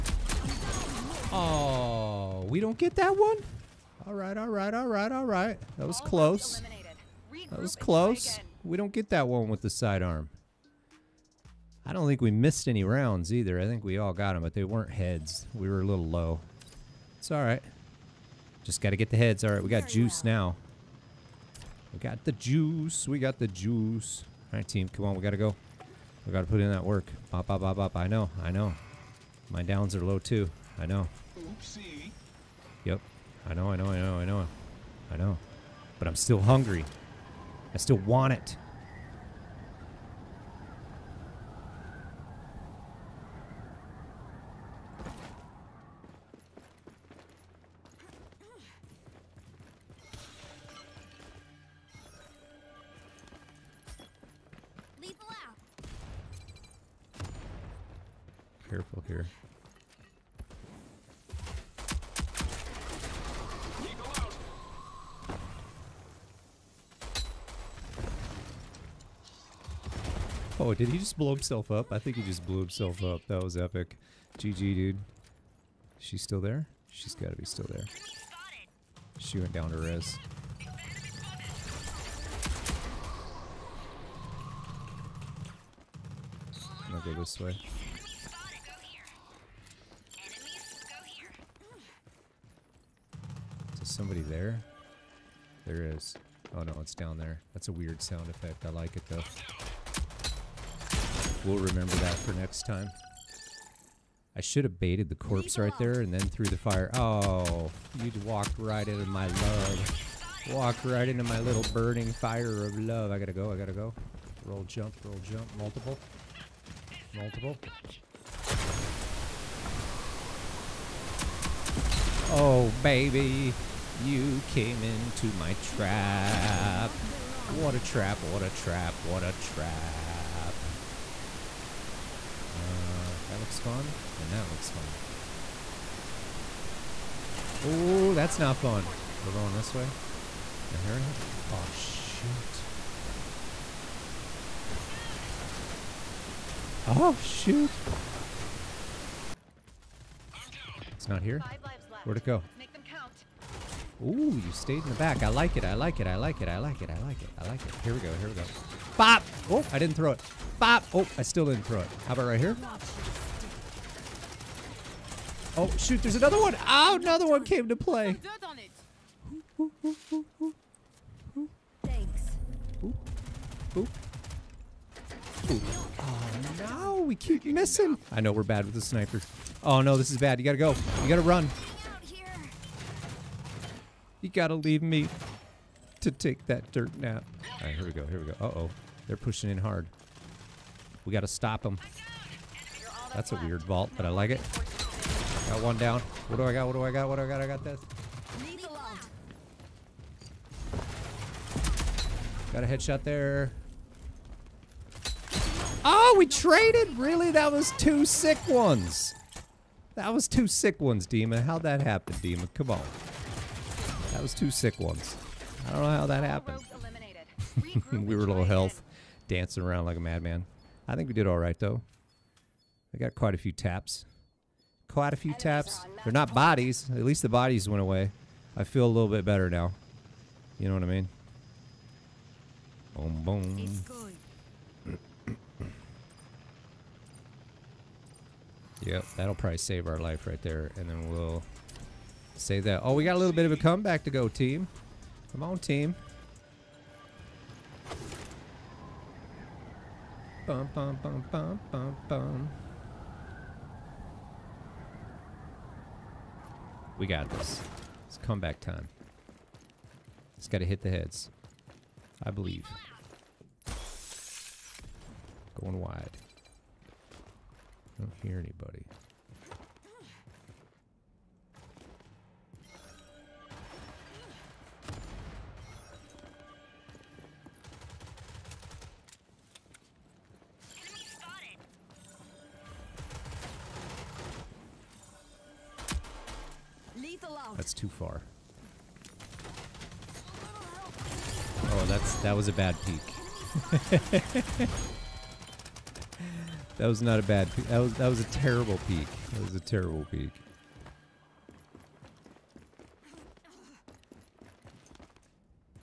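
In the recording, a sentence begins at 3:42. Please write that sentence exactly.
I got quite a few taps.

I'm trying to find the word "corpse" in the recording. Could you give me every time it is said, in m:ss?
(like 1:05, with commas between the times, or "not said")
1:45.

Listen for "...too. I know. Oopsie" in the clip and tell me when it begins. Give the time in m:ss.
0:30.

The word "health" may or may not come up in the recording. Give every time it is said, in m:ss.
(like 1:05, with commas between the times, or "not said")
3:38.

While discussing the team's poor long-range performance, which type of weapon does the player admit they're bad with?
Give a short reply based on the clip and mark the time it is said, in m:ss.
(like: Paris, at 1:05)
Snipers, at 2:58.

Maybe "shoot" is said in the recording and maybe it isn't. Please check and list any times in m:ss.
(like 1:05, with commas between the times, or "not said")
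2:21, 2:27, 2:45.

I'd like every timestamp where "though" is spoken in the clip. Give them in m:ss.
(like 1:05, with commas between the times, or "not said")
1:39, 3:41.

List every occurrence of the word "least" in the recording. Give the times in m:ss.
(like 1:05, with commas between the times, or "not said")
3:47.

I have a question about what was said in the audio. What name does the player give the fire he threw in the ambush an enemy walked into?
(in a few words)
burning fire of love.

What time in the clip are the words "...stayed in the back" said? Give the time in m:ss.
2:34.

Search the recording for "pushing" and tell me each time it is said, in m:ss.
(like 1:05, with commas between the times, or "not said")
3:09.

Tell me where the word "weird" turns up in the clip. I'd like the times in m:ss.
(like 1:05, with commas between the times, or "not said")
1:37, 3:13.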